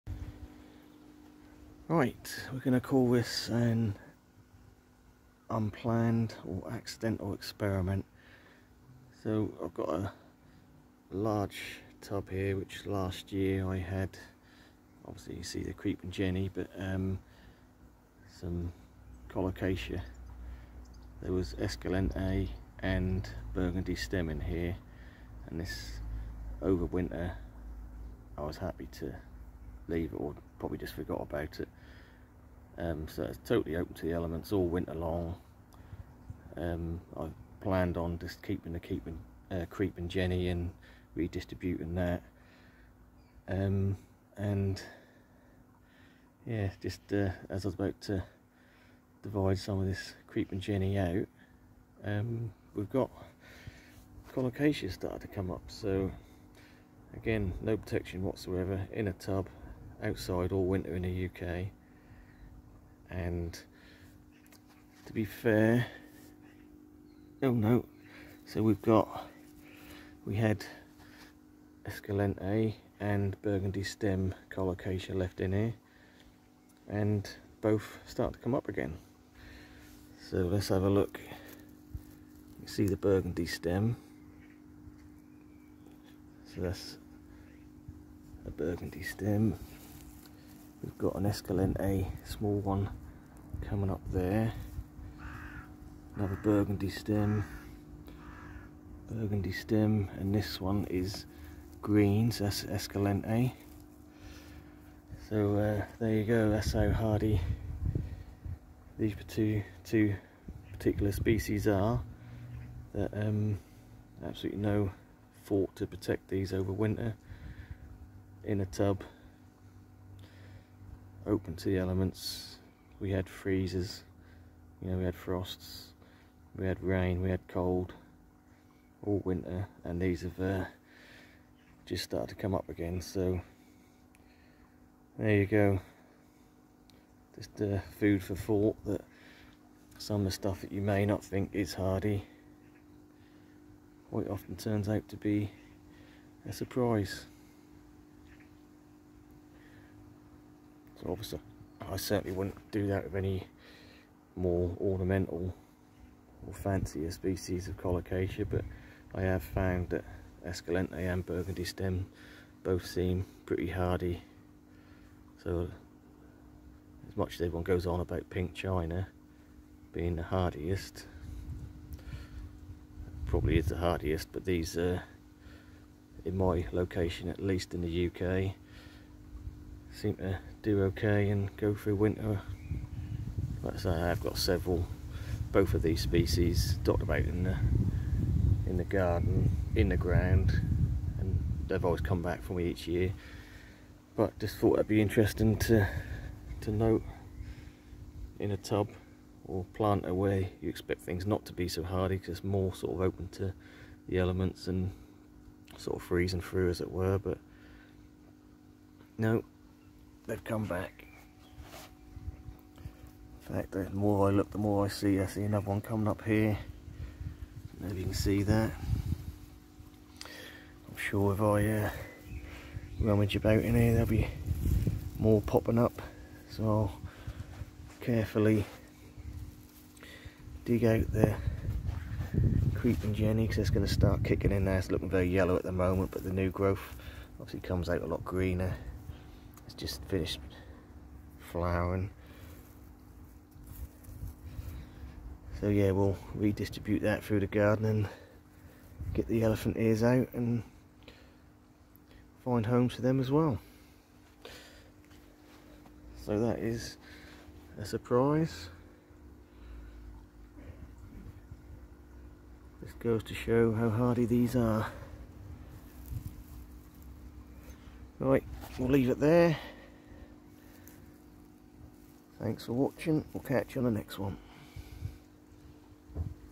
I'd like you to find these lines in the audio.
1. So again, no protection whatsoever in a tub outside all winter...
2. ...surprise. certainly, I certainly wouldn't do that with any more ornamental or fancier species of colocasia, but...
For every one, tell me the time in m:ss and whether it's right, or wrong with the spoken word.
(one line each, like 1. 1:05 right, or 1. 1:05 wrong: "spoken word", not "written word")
1. 0:55 right
2. 2:26 wrong: "obviously", not "certainly".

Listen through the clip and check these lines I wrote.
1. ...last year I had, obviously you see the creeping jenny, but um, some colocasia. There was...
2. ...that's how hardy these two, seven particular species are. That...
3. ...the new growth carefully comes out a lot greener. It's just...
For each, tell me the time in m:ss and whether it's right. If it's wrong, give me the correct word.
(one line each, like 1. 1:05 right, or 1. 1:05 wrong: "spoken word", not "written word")
1. 0:12 right
2. 1:46 wrong: "two", not "seven"
3. 3:56 wrong: "obviously", not "carefully".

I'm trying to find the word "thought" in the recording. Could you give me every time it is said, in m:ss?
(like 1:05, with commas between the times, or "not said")
2:18, 3:14.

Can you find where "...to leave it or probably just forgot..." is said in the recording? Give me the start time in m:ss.
0:29.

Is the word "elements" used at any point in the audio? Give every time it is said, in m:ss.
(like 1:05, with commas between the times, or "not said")
0:34, 2:01, 3:24.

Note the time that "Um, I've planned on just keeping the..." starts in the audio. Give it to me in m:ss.
0:36.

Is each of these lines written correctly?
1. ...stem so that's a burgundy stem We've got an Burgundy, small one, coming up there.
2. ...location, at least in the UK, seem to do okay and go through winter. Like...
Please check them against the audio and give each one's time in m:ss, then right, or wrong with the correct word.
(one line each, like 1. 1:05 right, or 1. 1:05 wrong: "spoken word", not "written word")
1. 1:23 wrong: "Escalente", not "Burgundy"
2. 2:56 right.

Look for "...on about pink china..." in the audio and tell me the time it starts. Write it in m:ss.
2:47.